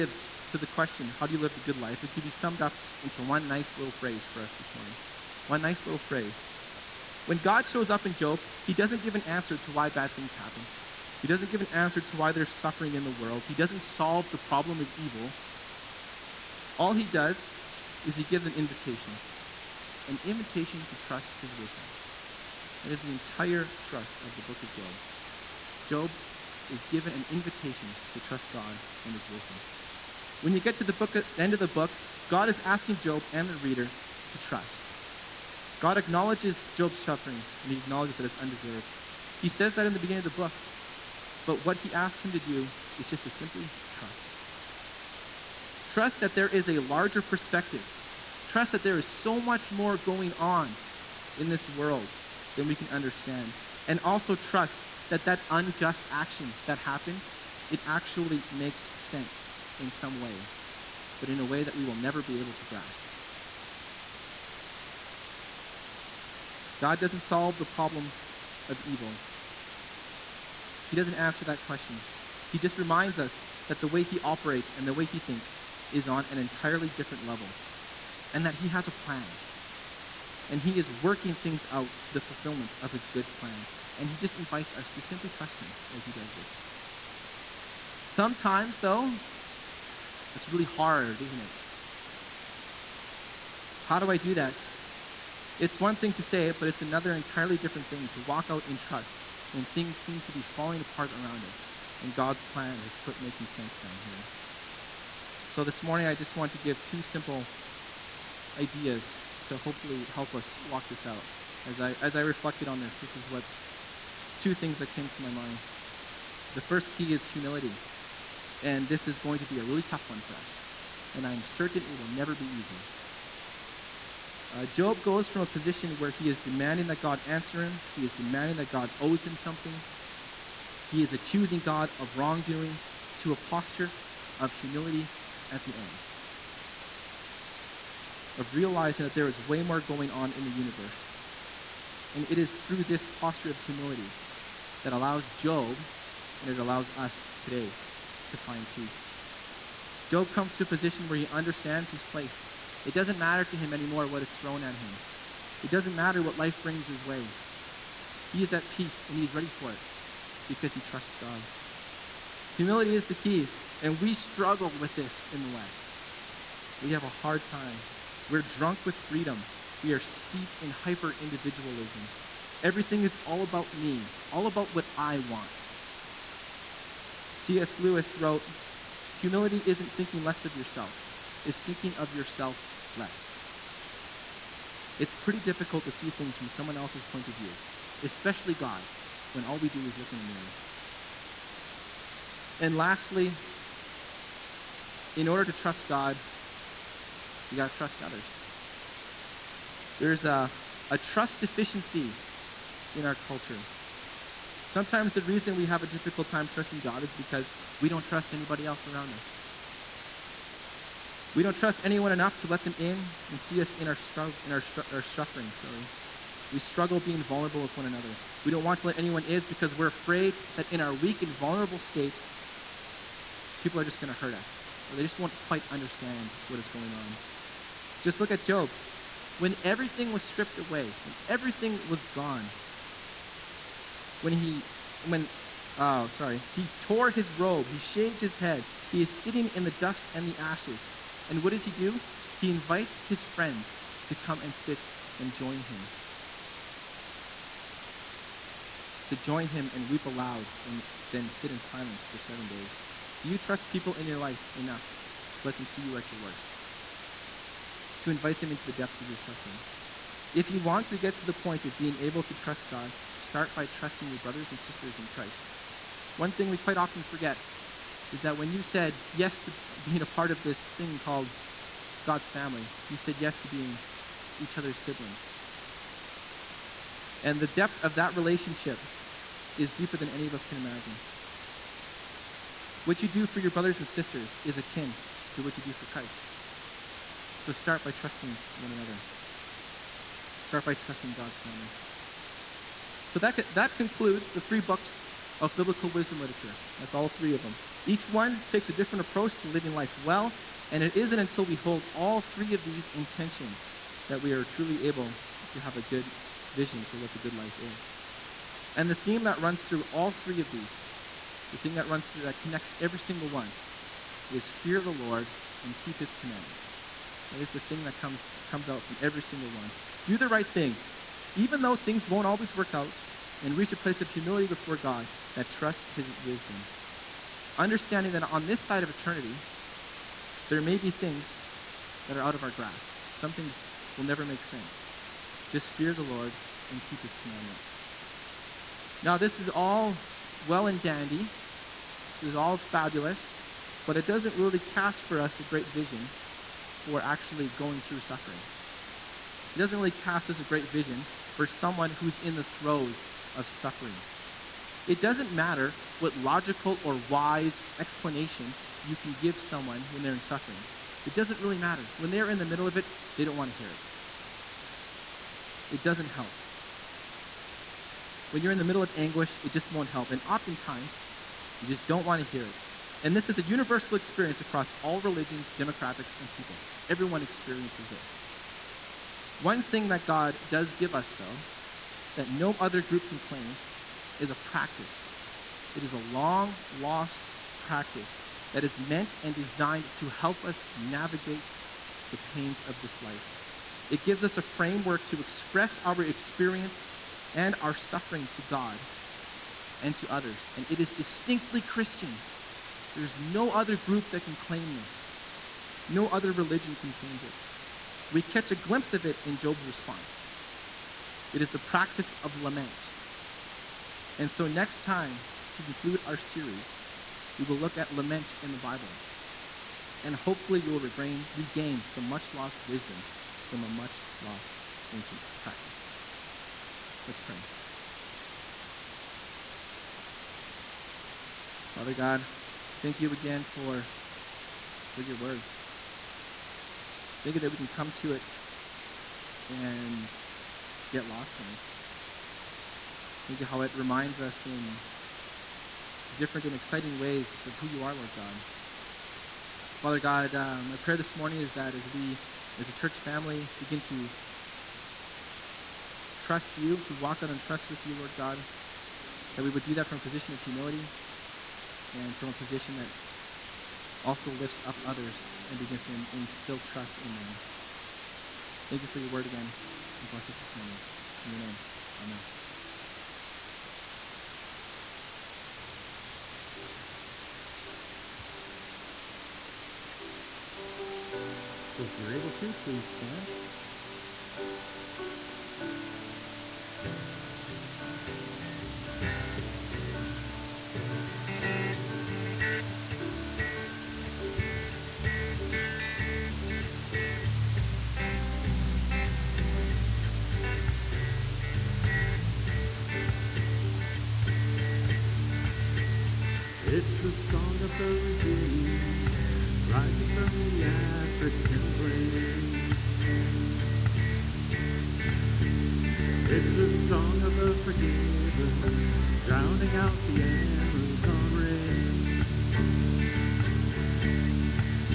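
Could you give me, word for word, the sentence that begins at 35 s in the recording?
God acknowledges Job's suffering, and he acknowledges that it's undeserved.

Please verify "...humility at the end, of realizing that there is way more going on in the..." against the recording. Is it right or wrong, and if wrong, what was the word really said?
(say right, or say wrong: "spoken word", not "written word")
right.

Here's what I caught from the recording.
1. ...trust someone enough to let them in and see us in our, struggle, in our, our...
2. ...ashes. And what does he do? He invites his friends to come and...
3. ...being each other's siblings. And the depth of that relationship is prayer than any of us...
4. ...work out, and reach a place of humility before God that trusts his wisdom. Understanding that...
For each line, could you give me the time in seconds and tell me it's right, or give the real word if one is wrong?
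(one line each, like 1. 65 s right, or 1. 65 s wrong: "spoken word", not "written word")
1. 211 s wrong: "anyone", not "someone"
2. 240 s right
3. 273 s wrong: "deeper", not "prayer"
4. 322 s right.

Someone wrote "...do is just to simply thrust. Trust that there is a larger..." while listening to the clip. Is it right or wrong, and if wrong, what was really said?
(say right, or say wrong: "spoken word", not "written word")
wrong: "trust", not "thrust".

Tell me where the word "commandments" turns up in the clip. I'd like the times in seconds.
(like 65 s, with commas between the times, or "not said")
316 s, 337 s.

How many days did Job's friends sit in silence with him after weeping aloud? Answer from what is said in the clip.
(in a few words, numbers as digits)
7.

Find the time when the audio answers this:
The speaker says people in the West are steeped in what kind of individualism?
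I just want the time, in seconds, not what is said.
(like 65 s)
170 s.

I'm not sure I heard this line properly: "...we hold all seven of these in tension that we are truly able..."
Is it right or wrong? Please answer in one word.
wrong.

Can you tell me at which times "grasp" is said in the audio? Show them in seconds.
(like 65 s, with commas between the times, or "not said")
62 s, 332 s.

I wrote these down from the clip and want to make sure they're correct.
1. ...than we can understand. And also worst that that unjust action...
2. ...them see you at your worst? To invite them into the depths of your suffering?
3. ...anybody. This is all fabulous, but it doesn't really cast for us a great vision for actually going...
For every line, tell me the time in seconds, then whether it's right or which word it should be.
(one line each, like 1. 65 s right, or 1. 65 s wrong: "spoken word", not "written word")
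1. 52 s wrong: "trust", not "worst"
2. 255 s right
3. 340 s wrong: "dandy", not "anybody".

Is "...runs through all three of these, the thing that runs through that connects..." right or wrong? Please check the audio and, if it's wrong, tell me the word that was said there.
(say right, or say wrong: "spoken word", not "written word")
right.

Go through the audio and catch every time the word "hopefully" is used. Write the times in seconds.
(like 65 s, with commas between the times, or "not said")
109 s, 420 s.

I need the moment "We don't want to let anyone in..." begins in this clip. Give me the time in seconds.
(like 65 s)
218 s.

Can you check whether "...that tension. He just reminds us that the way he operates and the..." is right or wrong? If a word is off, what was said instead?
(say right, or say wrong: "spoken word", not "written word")
wrong: "question", not "tension".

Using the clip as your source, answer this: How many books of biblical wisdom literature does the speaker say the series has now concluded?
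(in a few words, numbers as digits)
3.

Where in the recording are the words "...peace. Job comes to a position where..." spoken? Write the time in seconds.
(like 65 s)
148 s.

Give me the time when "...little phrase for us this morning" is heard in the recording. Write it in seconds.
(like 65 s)
3 s.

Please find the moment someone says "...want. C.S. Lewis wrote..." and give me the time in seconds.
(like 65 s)
175 s.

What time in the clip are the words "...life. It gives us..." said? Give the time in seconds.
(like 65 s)
393 s.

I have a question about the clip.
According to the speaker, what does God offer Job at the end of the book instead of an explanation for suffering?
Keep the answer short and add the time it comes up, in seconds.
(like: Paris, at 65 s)
An invitation to trust his wisdom, at 20 s.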